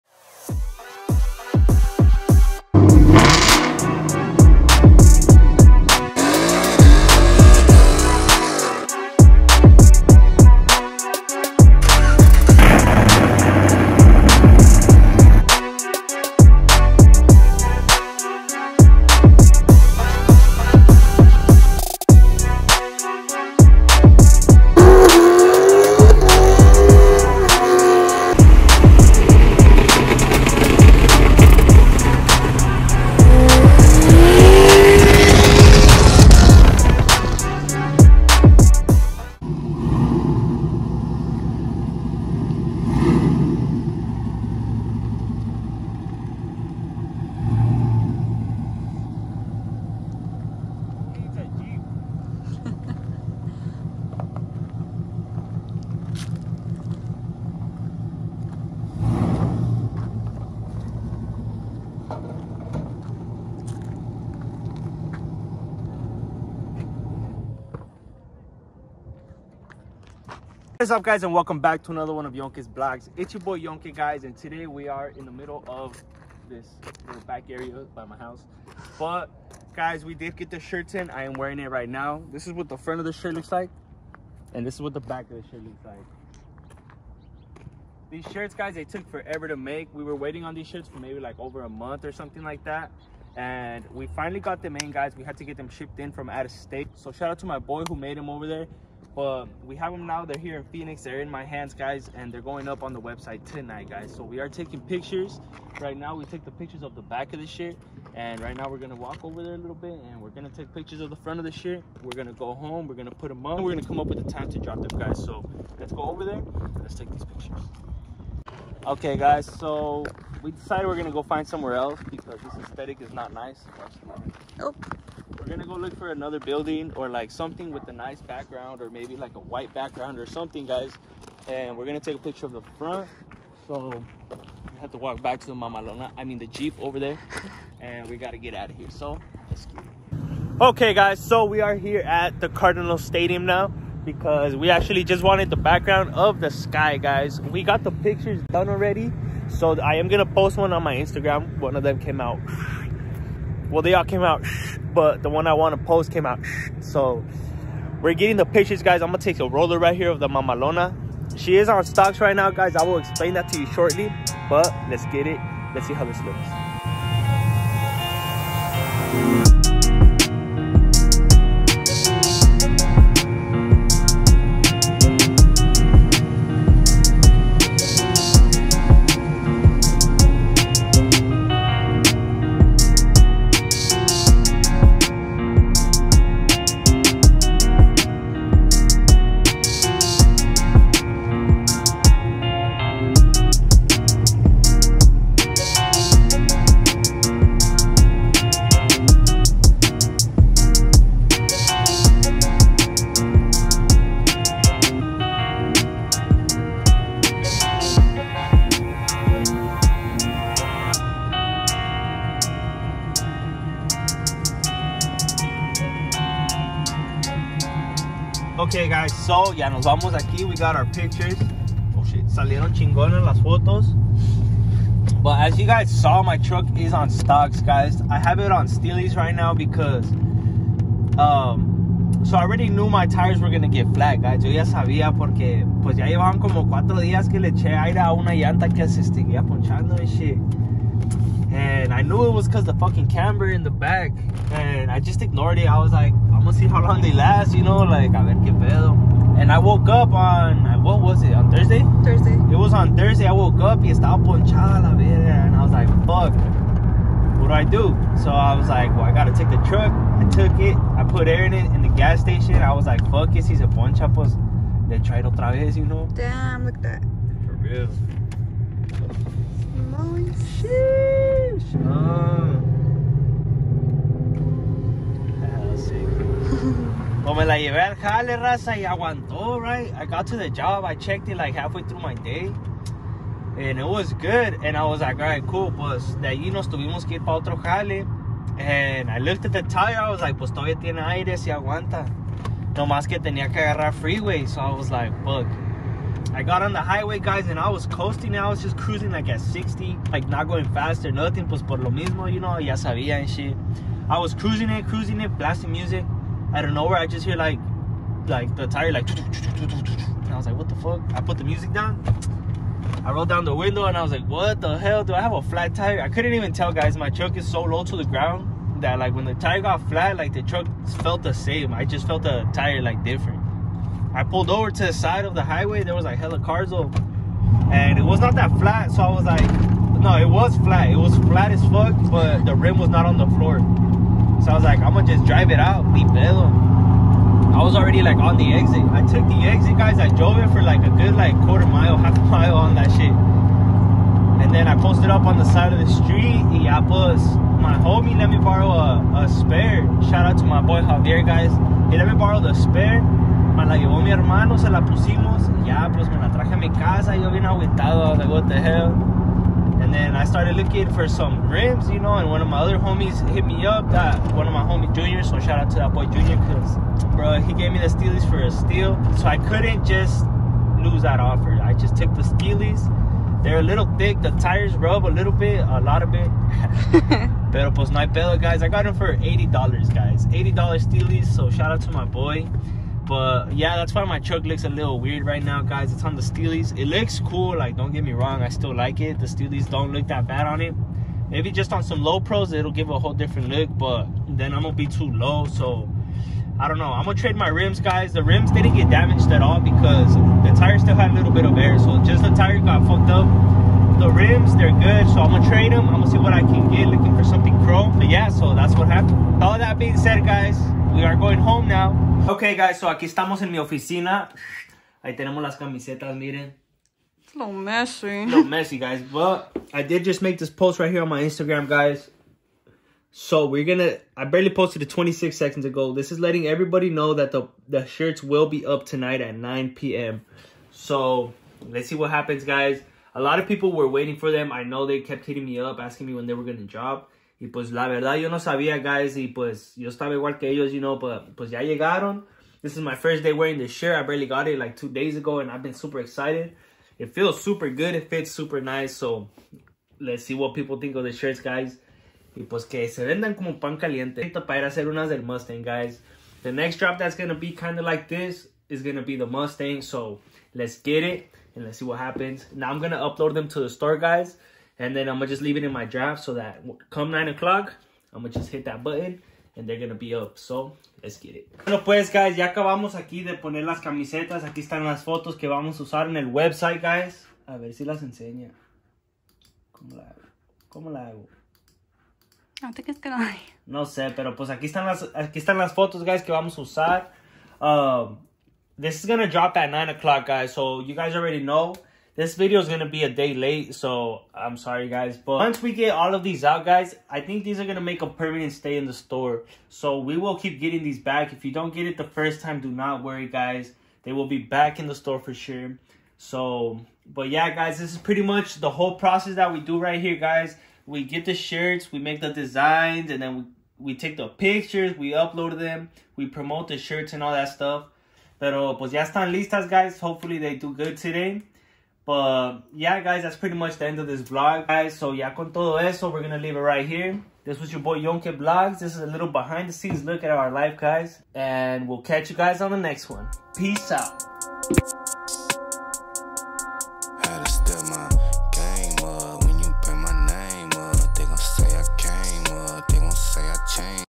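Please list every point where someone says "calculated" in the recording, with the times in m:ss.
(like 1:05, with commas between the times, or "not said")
not said.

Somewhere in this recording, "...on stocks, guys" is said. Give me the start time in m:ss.
3:46.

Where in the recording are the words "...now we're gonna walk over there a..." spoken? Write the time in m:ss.
1:48.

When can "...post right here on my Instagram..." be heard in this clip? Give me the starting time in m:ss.
7:00.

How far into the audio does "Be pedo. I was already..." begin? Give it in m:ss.
5:35.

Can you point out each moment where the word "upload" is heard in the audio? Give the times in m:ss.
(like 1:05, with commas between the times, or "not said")
7:42, 8:35.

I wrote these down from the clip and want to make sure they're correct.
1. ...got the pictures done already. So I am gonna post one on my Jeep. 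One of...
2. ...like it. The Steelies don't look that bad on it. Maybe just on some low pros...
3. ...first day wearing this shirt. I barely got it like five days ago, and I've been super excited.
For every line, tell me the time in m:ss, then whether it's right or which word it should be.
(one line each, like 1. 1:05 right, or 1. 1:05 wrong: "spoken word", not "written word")
1. 2:27 wrong: "Instagram", not "Jeep"
2. 6:28 right
3. 7:22 wrong: "two", not "five".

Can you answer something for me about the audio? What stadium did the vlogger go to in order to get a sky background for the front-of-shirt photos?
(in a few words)
Cardinal Stadium.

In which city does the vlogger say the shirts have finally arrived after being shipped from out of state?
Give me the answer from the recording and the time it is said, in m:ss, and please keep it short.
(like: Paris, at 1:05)
Phoenix, at 1:40.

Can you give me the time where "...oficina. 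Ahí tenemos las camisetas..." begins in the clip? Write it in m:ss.
6:53.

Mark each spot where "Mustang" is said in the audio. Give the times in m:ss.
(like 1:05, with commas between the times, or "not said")
7:35, 7:39.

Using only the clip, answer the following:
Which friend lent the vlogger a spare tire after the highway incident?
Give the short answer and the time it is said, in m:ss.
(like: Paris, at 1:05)
Javier, at 5:50.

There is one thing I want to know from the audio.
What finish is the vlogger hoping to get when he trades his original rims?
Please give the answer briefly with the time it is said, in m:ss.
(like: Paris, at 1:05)
Chrome, at 6:47.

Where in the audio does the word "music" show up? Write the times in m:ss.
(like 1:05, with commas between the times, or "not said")
5:05, 5:11.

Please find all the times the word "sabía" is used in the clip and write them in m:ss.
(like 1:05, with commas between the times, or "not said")
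3:54, 5:02, 7:18.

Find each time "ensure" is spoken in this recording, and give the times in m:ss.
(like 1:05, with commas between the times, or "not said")
not said.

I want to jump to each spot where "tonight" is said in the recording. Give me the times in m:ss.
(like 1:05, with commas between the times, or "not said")
1:43, 7:08.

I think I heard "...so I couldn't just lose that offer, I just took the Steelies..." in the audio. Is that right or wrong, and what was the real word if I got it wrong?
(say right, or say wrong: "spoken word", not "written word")
right.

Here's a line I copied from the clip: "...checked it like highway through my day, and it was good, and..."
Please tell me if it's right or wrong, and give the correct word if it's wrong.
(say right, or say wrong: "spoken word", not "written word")
wrong: "halfway", not "highway".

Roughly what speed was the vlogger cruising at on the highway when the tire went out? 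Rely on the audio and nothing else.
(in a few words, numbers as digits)
60.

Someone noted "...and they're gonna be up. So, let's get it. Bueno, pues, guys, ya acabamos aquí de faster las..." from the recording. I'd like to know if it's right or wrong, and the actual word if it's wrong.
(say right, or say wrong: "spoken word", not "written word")
wrong: "poner", not "faster".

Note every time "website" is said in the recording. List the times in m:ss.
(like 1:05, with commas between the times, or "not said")
1:43, 7:56.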